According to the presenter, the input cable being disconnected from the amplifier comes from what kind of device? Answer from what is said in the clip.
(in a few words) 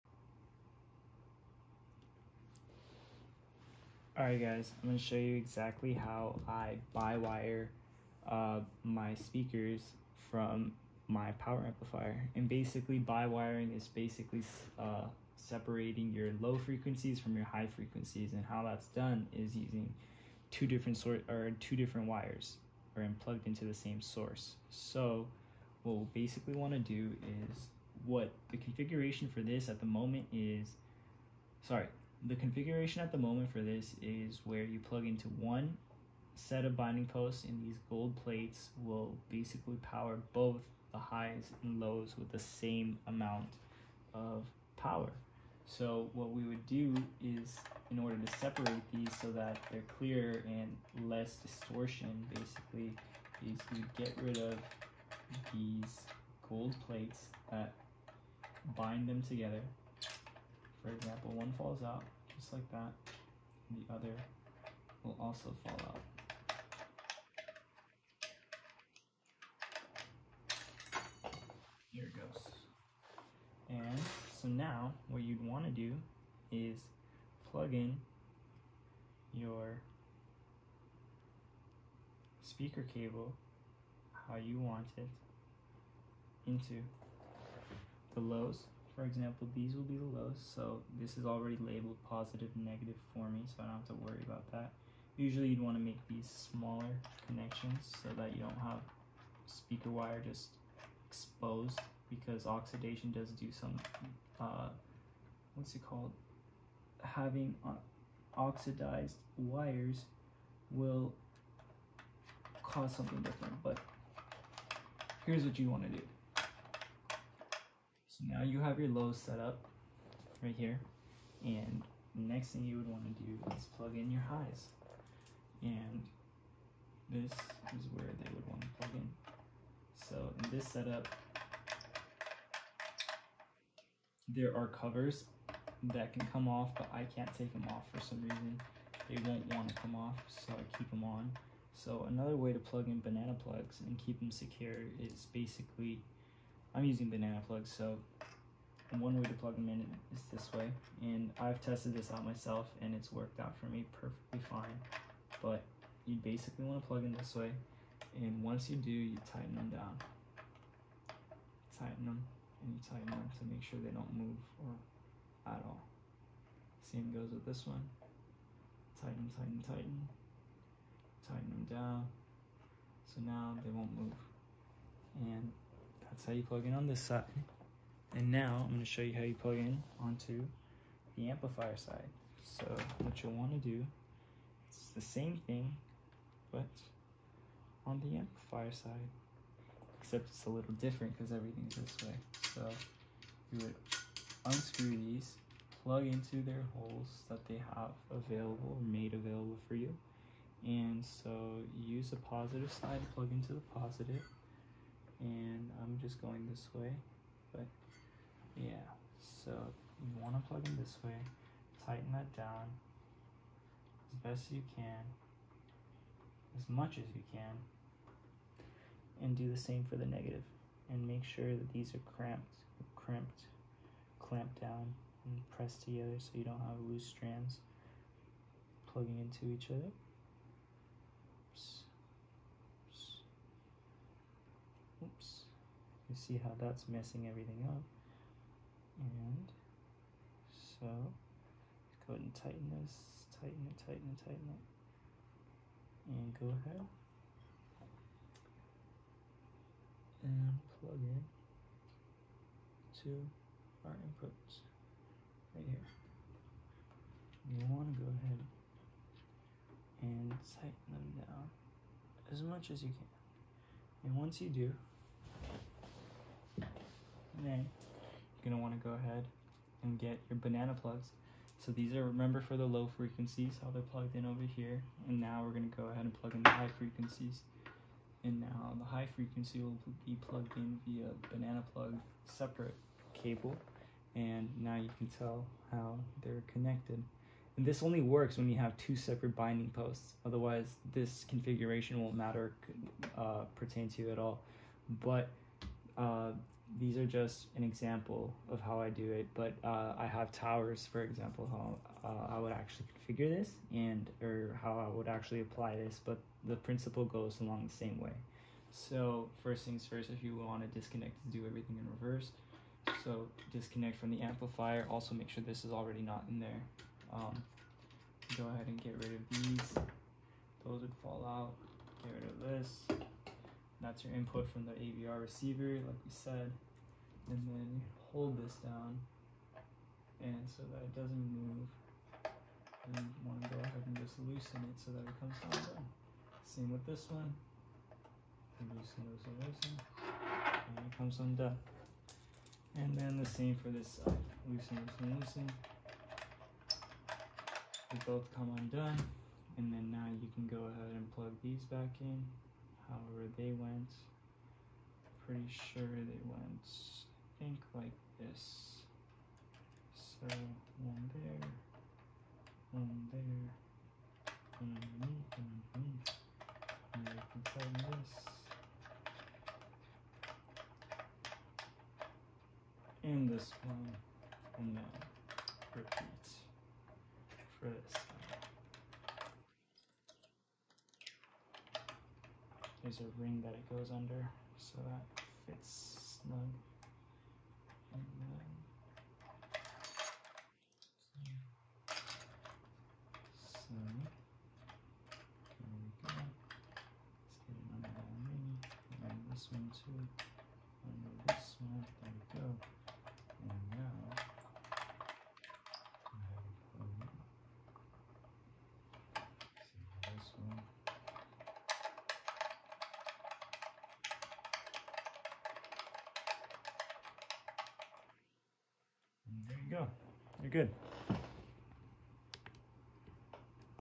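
AVR receiver.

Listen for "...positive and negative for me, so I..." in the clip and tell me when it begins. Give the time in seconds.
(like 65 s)
92 s.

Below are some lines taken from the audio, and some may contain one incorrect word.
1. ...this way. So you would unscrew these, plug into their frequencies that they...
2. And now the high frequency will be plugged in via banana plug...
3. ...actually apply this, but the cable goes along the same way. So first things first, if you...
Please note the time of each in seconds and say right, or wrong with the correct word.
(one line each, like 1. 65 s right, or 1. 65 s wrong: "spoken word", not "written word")
1. 191 s wrong: "holes", not "frequencies"
2. 278 s right
3. 305 s wrong: "principle", not "cable".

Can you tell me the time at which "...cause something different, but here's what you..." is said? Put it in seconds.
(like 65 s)
112 s.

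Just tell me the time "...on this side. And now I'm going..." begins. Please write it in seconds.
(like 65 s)
176 s.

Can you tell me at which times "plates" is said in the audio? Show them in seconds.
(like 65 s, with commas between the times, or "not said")
38 s, 56 s.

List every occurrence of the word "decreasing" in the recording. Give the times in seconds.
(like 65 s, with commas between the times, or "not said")
not said.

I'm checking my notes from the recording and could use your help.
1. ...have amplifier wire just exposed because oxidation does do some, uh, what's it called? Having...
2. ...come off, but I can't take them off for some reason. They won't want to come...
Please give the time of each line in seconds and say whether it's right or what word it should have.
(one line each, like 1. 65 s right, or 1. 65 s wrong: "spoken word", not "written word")
1. 98 s wrong: "speaker", not "amplifier"
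2. 136 s right.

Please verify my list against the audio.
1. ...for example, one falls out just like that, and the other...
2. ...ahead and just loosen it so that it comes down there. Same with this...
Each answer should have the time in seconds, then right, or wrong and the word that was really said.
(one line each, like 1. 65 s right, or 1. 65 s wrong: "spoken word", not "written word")
1. 60 s right
2. 333 s right.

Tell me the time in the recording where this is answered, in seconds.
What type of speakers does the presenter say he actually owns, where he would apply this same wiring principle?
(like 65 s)
300 s.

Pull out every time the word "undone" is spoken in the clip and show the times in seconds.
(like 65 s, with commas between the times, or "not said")
341 s, 348 s.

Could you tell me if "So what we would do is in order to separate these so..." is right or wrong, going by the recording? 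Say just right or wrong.
right.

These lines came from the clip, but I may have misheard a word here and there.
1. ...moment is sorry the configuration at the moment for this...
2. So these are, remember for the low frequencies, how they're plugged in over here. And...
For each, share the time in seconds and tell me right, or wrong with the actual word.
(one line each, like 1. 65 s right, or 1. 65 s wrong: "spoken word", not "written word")
1. 29 s right
2. 271 s right.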